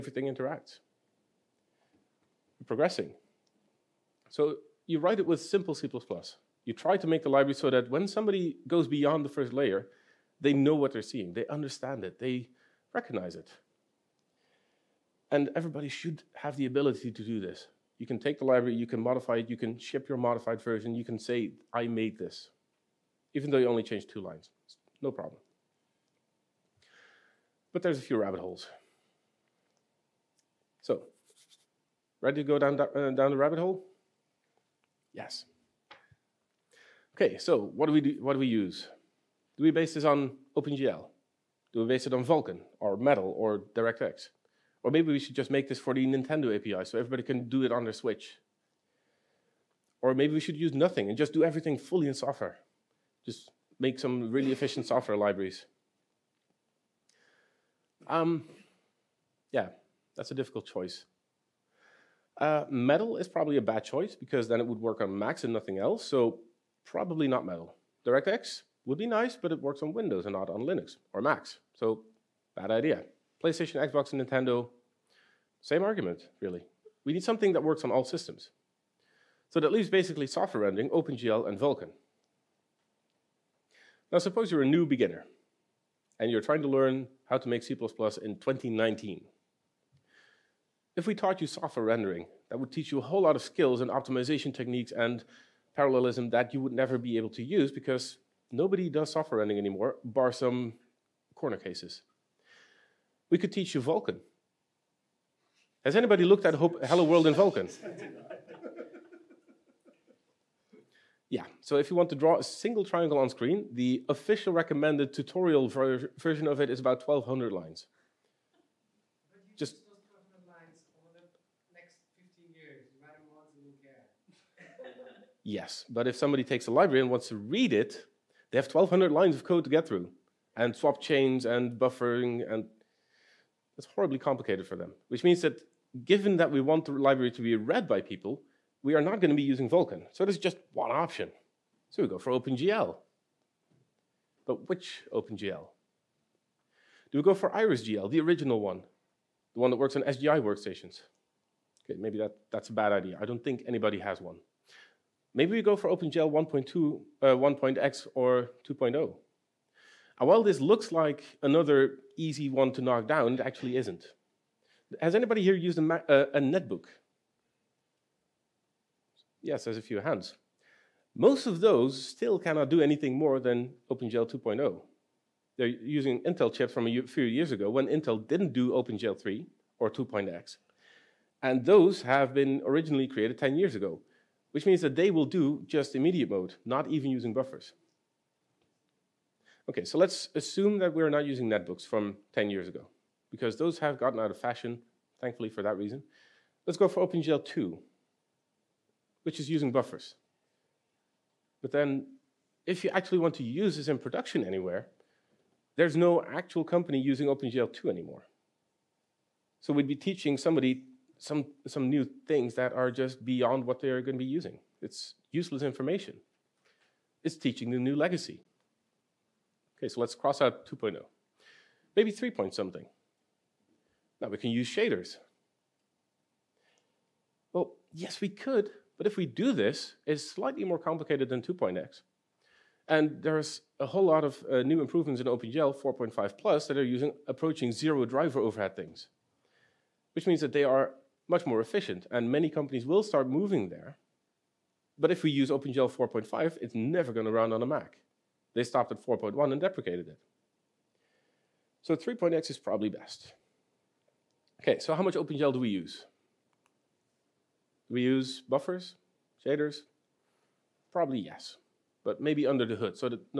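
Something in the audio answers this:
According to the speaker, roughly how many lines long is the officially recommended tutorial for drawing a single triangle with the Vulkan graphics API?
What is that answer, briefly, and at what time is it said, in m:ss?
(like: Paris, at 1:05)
1,200, at 1:56.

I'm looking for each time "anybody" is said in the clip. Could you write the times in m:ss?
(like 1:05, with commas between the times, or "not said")
1:45, 2:33, 2:45.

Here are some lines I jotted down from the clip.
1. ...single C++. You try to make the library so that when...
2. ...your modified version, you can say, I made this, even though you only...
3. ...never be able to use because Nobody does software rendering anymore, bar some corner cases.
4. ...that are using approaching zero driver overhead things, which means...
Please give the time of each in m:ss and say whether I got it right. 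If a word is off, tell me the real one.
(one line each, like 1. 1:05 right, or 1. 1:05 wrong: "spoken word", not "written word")
1. 0:05 wrong: "simple", not "single"
2. 0:20 right
3. 1:36 right
4. 3:56 right.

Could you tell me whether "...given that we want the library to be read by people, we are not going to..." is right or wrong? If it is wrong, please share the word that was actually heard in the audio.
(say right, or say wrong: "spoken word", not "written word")
right.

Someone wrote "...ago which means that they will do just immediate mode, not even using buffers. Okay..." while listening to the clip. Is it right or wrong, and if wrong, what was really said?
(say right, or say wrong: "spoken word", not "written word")
right.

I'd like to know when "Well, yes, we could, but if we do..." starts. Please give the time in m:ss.
3:47.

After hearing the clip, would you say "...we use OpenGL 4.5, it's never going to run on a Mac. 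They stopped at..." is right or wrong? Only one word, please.
right.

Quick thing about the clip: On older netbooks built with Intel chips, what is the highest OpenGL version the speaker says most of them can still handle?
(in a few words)
OpenGL 2.0.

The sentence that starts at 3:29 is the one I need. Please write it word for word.
So we'd be teaching somebody some some new things that are just beyond what they're going to be using.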